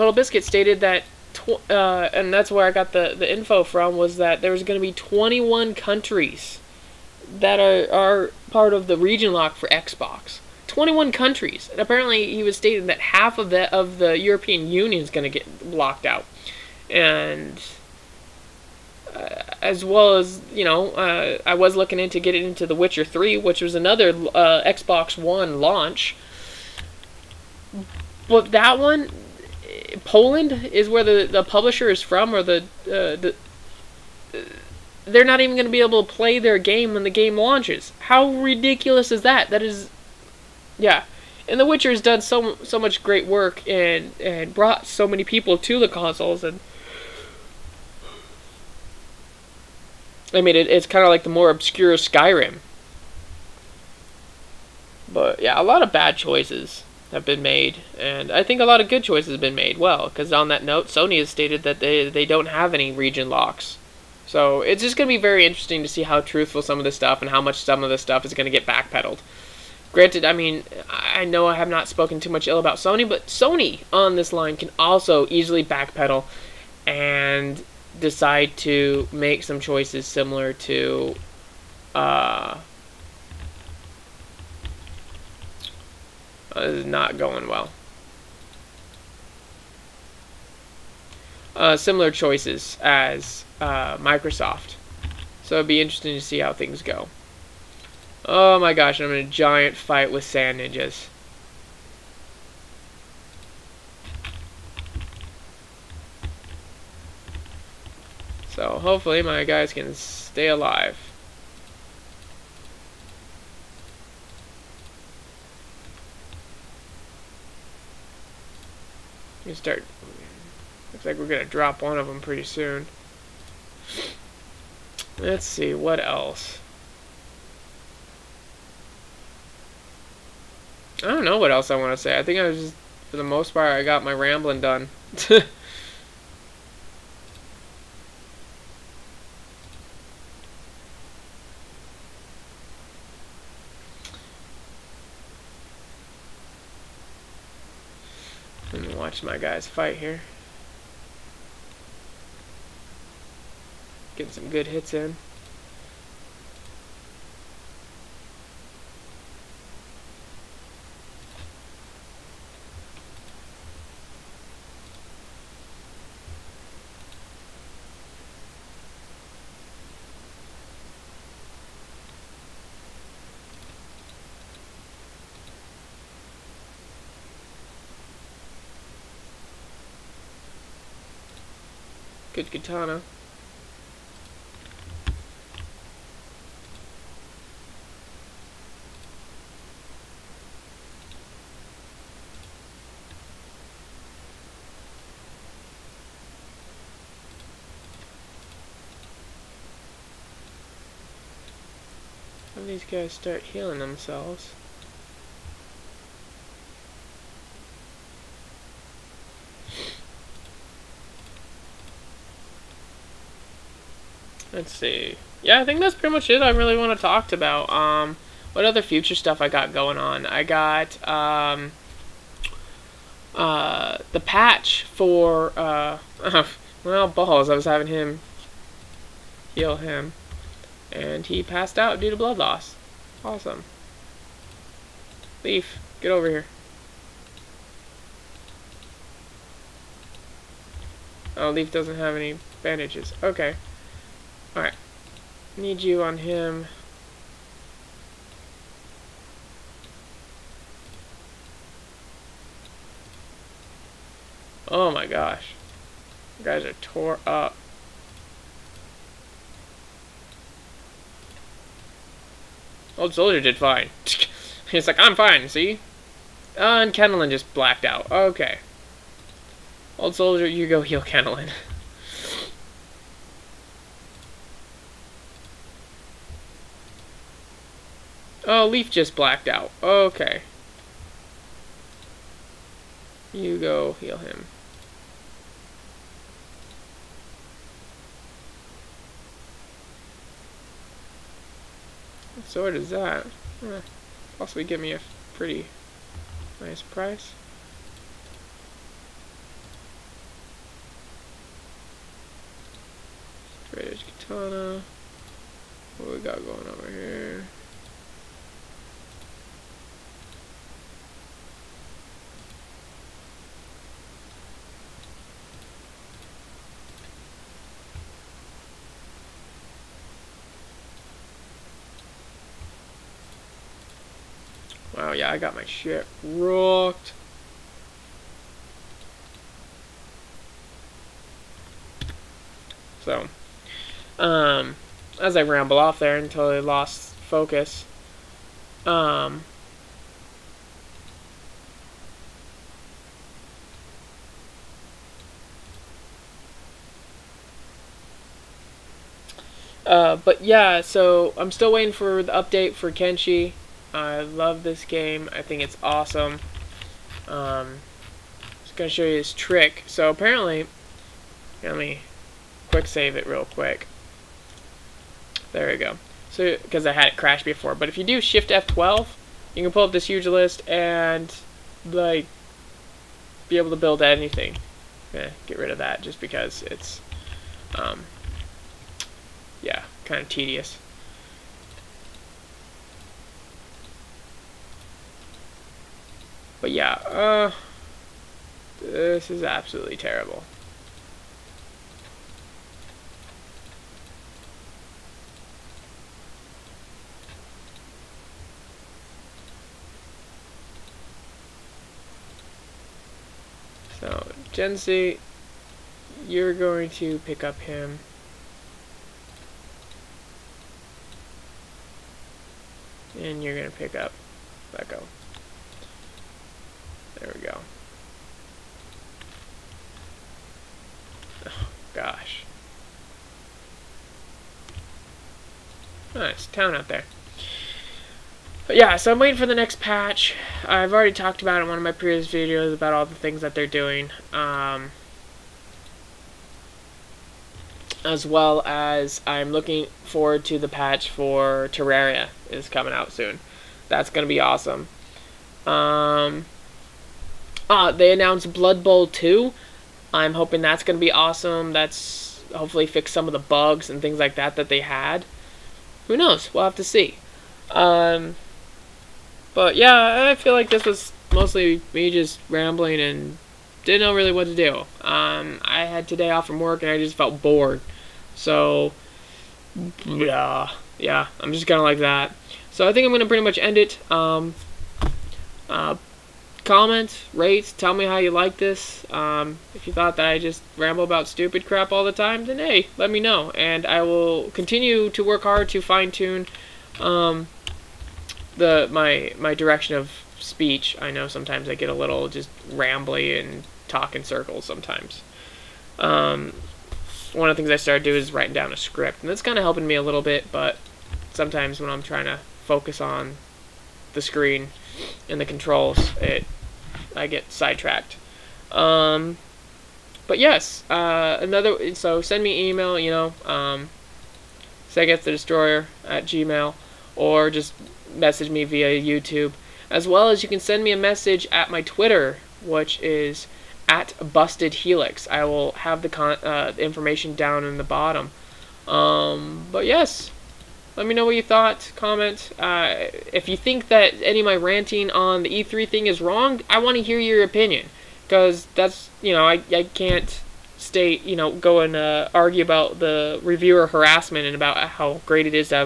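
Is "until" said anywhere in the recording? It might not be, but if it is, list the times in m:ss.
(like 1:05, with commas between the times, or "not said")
5:36.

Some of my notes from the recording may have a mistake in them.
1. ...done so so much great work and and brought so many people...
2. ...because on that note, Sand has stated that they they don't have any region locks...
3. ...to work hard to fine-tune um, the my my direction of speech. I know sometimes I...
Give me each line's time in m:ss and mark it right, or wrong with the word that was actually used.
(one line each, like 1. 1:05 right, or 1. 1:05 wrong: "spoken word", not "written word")
1. 0:42 right
2. 1:00 wrong: "Sony", not "Sand"
3. 8:05 right.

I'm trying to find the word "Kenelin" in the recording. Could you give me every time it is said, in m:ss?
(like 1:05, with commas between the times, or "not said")
4:26, 4:31.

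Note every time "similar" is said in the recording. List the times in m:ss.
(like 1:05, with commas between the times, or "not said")
1:20, 1:31.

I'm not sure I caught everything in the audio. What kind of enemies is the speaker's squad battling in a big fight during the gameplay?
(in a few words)
Sand Ninjas.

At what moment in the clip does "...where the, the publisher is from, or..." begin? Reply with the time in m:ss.
0:30.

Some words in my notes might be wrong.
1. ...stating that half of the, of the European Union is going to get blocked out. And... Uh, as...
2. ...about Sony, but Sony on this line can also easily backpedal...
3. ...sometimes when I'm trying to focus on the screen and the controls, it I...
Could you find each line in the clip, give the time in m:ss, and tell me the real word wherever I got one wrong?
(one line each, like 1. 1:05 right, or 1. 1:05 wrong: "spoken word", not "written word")
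1. 0:12 right
2. 1:12 right
3. 8:21 right.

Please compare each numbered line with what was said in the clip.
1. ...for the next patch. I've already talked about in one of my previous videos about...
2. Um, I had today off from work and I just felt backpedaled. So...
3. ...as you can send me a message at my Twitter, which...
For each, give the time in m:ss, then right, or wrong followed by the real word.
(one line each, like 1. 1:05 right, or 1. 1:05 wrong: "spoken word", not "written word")
1. 7:09 right
2. 7:45 wrong: "bored", not "backpedaled"
3. 8:40 right.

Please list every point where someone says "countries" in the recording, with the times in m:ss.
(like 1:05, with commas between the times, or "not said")
0:05, 0:11.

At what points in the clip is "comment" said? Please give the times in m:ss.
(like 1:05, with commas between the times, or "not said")
7:56, 8:51.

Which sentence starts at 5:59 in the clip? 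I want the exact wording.
So apparently, let me quick save it real quick.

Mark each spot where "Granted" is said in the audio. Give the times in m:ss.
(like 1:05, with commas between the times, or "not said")
1:09.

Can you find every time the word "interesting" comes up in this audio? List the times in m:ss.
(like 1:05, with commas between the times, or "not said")
1:05, 1:35.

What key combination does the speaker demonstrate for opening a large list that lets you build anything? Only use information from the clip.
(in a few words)
Shift F12.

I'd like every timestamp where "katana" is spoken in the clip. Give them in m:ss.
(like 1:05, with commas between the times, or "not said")
3:02, 5:04.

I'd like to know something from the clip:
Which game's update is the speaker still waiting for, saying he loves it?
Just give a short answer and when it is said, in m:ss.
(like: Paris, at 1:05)
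Kenshi, at 5:52.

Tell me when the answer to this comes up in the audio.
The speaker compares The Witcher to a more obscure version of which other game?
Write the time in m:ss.
0:51.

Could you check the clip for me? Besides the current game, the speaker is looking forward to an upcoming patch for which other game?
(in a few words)
Terraria.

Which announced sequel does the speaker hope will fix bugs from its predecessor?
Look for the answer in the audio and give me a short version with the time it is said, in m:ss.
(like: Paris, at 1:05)
Blood Bowl 2, at 7:28.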